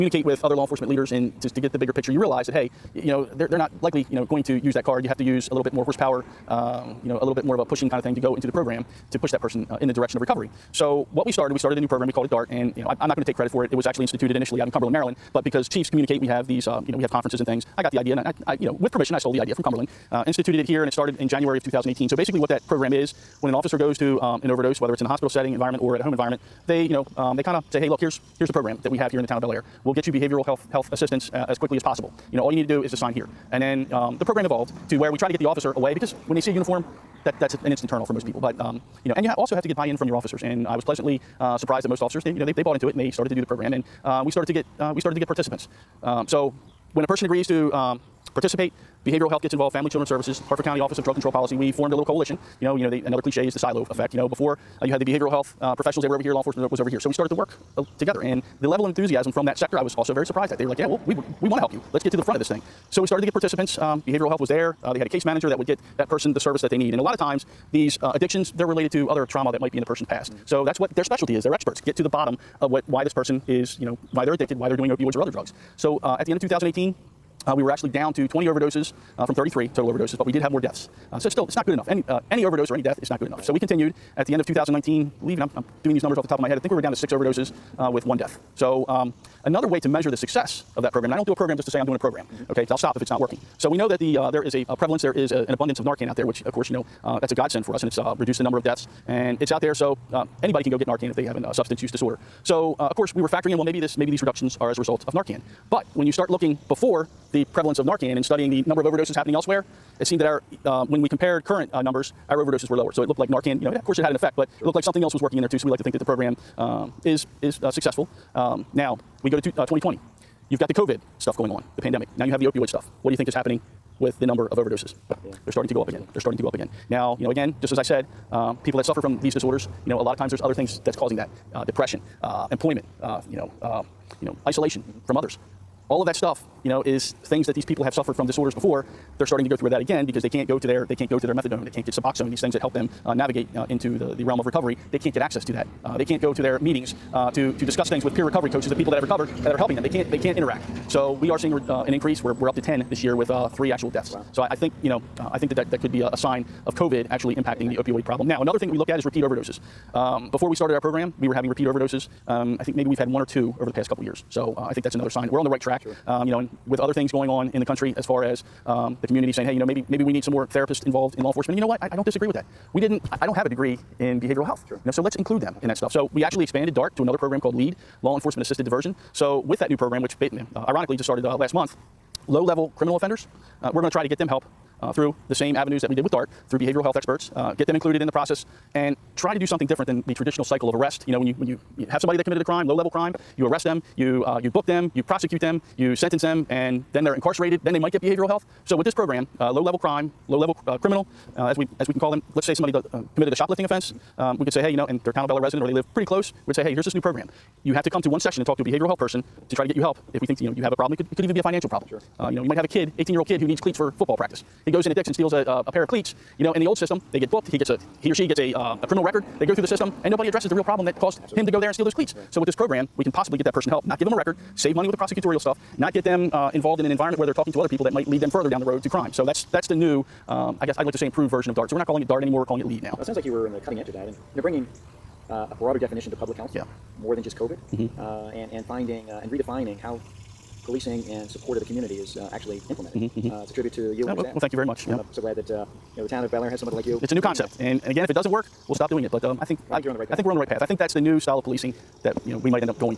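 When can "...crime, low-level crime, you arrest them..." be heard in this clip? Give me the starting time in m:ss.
3:12.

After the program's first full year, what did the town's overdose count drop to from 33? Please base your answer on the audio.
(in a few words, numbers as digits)
20.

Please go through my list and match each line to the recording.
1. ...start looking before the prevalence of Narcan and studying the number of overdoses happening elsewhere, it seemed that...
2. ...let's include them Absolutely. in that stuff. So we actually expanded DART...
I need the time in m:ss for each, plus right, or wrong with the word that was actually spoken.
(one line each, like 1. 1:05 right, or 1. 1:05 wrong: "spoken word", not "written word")
1. 1:46 right
2. 2:55 right.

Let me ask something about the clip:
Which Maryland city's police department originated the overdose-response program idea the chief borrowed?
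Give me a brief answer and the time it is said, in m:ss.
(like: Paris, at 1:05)
Cumberland, Maryland, at 0:14.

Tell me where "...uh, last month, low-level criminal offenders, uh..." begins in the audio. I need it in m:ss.
3:01.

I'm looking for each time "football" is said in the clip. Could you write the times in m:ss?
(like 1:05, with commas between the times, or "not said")
3:33.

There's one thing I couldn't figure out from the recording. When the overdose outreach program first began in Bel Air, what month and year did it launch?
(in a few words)
January 2018.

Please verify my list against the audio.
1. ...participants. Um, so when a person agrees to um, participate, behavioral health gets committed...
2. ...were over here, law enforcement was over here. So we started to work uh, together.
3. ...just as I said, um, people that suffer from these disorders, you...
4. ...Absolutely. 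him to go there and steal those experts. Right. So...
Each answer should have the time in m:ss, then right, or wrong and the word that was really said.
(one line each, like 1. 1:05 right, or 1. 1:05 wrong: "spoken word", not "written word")
1. 0:45 wrong: "involved", not "committed"
2. 0:56 right
3. 2:07 right
4. 3:41 wrong: "cleats", not "experts".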